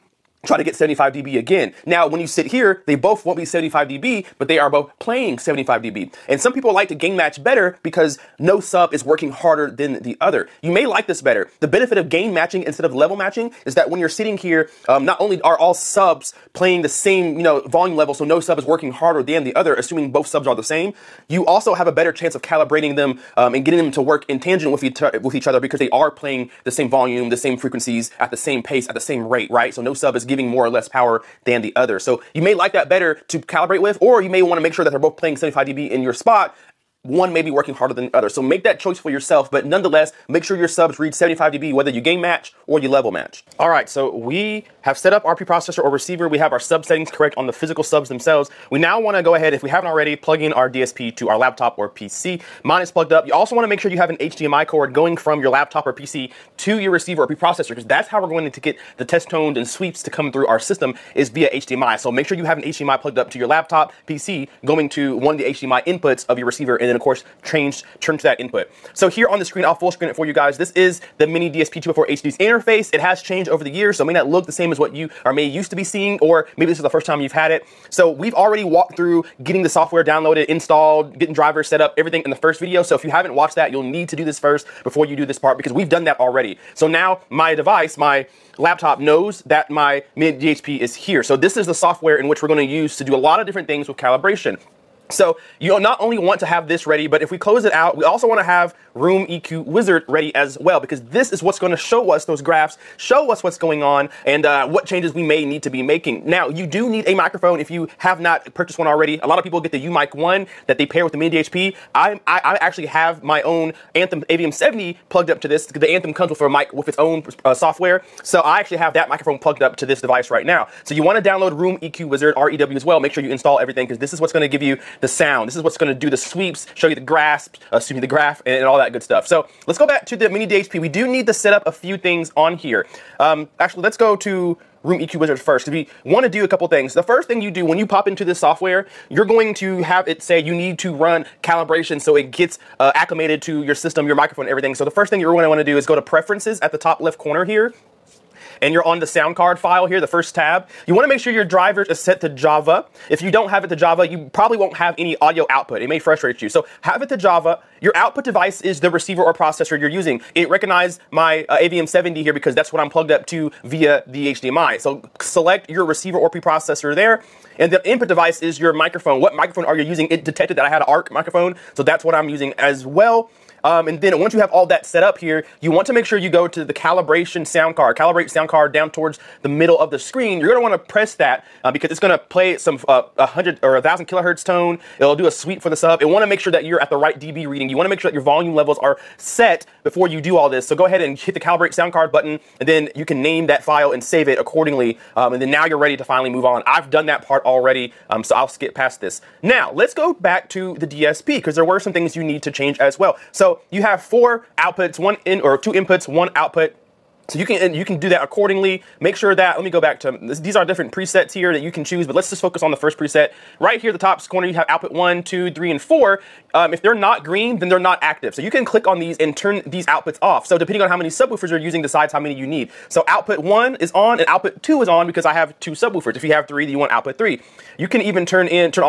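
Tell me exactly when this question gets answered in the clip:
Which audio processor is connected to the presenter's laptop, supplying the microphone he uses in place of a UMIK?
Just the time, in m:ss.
1:53.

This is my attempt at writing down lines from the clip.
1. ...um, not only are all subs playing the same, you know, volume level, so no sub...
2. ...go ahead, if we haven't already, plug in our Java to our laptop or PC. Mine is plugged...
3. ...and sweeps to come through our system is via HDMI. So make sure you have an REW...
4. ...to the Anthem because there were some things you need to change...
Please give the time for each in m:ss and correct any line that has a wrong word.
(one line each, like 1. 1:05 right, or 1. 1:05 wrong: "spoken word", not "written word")
1. 0:14 right
2. 0:49 wrong: "DSP", not "Java"
3. 0:59 wrong: "HDMI", not "REW"
4. 3:20 wrong: "DSP", not "Anthem".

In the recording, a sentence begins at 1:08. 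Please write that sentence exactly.
So here on the screen, I'll full screen it for you guys.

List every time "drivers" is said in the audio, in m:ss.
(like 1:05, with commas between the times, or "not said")
1:21, 2:31.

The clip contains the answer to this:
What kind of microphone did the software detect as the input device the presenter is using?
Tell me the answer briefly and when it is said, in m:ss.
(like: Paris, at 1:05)
ARC microphone, at 2:50.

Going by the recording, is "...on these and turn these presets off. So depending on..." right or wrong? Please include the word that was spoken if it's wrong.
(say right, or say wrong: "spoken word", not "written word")
wrong: "outputs", not "presets".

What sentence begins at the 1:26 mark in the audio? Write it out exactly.
So now my device, my laptop knows that my mini DSP is here.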